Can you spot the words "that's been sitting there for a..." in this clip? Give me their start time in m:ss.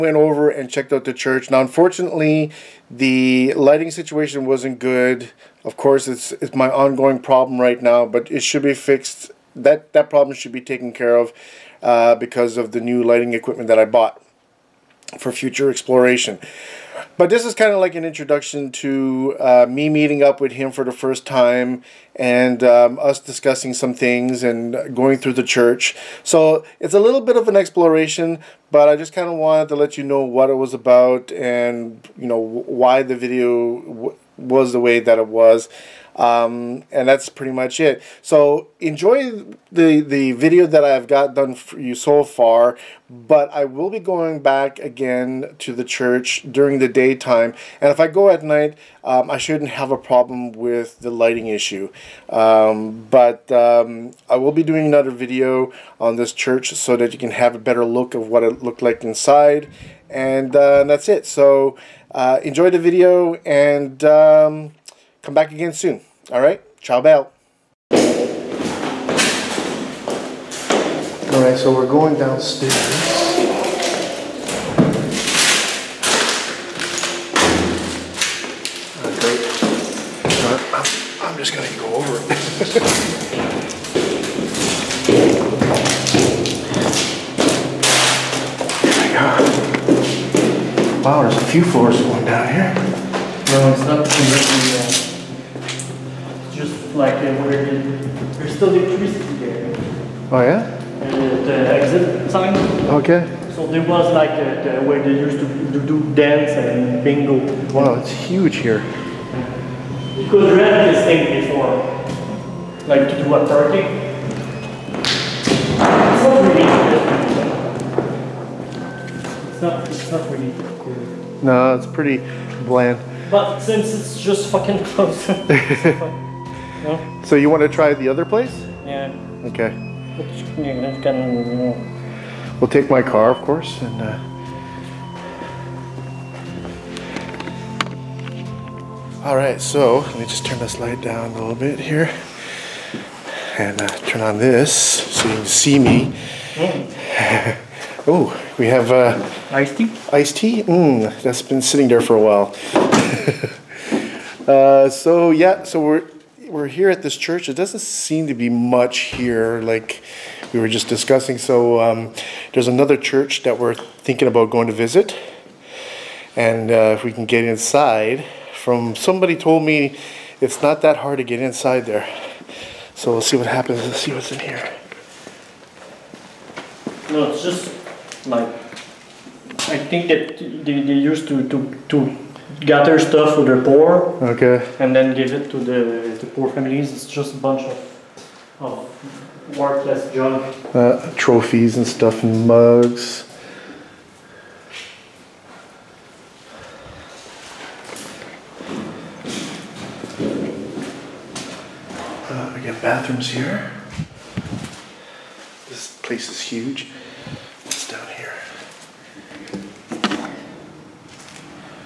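2:31.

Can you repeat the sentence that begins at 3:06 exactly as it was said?
It's just a bunch of, of worthless junk.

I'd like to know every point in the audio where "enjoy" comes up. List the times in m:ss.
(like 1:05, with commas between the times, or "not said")
0:38, 1:02.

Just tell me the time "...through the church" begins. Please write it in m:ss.
0:25.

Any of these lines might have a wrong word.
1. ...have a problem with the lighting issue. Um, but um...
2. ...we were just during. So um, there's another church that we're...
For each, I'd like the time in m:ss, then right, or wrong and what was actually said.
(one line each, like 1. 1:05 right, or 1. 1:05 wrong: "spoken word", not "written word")
1. 0:49 right
2. 2:40 wrong: "discussing", not "during".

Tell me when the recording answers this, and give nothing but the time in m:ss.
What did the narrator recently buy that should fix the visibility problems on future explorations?
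0:12.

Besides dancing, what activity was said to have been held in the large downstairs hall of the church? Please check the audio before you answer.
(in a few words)
Bingo.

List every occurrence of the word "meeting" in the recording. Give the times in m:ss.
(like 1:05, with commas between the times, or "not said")
0:19.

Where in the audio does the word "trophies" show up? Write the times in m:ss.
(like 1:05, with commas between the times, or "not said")
3:11.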